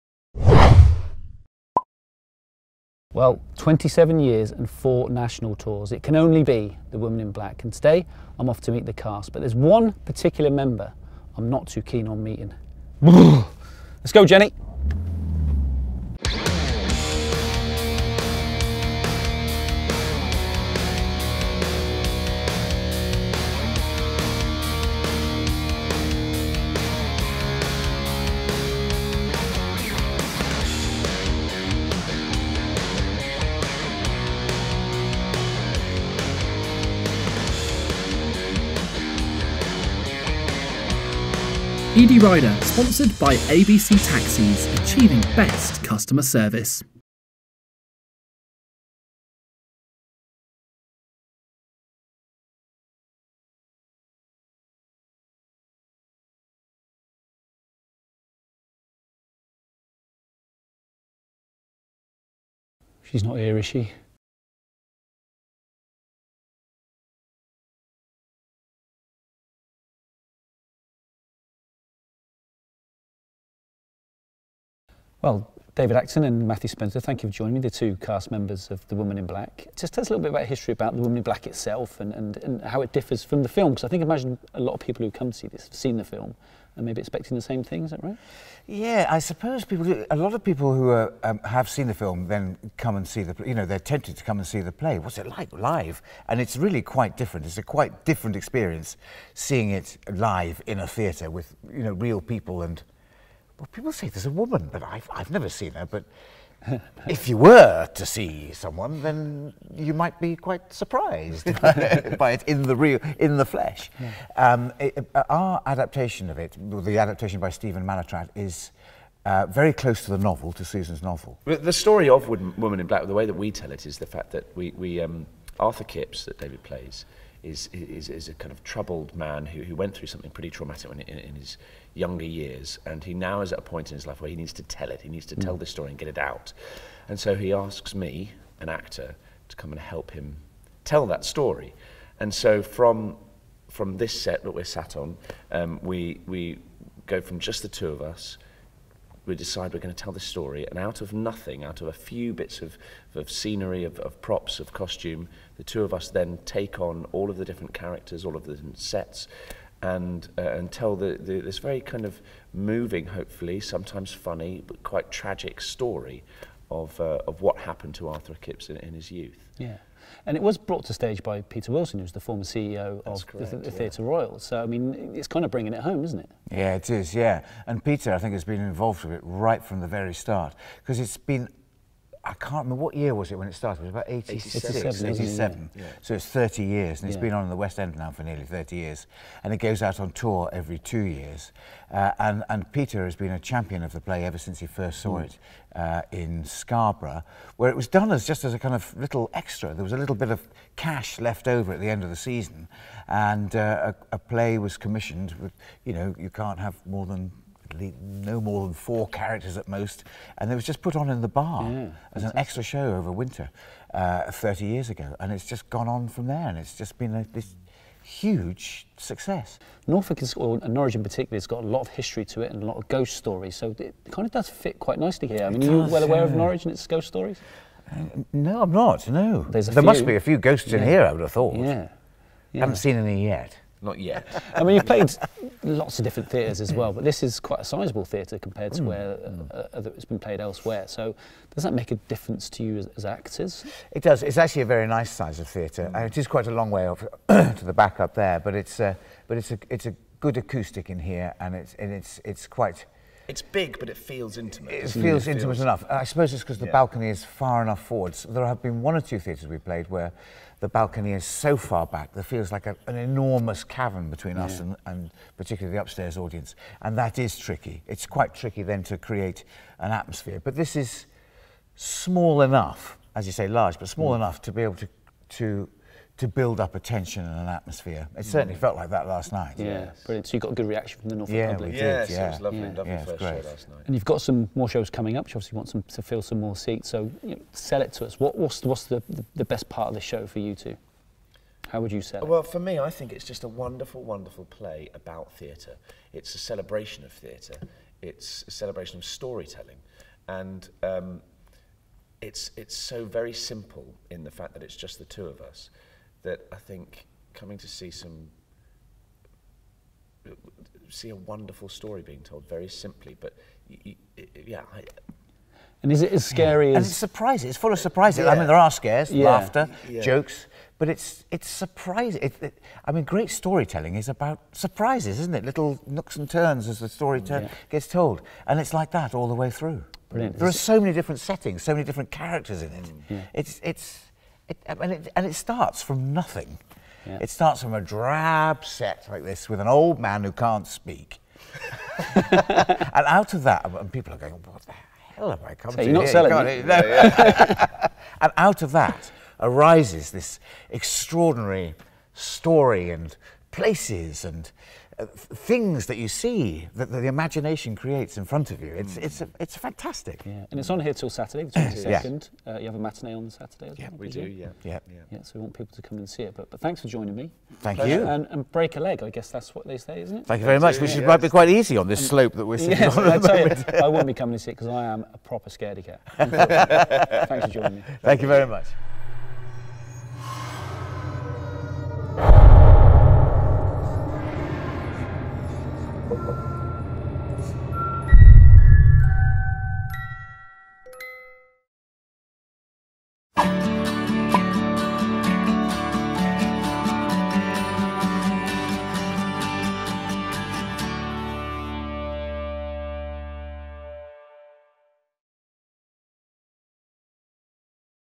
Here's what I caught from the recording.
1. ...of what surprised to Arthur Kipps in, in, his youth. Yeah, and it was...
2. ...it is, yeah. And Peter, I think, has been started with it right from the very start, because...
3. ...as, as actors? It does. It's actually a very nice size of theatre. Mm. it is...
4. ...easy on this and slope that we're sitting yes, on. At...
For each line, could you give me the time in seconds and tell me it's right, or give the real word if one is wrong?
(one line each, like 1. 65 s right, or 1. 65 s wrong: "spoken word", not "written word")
1. 167 s wrong: "happened", not "surprised"
2. 176 s wrong: "involved", not "started"
3. 242 s right
4. 371 s right.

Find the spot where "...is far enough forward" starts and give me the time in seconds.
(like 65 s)
257 s.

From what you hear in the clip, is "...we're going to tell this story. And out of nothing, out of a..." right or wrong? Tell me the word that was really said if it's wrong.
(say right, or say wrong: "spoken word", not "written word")
right.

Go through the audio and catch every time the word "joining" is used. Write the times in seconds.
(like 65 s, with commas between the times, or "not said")
77 s, 366 s, 377 s.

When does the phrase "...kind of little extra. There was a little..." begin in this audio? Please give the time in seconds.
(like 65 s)
198 s.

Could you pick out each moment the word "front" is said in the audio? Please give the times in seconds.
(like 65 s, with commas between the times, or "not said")
358 s.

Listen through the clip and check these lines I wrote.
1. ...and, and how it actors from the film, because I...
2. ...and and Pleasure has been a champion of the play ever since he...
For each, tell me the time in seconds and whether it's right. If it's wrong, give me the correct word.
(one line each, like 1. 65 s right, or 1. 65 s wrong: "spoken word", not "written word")
1. 82 s wrong: "differs", not "actors"
2. 192 s wrong: "Peter", not "Pleasure".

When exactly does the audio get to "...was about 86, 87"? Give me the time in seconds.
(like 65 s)
183 s.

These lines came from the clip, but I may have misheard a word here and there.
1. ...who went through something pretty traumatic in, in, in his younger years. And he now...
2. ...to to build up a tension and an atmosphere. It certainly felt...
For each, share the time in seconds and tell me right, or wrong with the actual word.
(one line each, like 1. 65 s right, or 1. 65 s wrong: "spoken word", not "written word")
1. 129 s right
2. 275 s right.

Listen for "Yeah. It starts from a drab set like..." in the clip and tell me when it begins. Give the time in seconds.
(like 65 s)
337 s.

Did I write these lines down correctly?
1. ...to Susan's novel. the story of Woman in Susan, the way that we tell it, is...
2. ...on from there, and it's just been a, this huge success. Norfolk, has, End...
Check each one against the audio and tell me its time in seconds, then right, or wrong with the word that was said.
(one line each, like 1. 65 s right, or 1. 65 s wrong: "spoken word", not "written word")
1. 120 s wrong: "Black", not "Susan"
2. 215 s wrong: "Norwich", not "End".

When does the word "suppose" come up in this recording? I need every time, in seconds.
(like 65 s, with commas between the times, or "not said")
89 s, 256 s.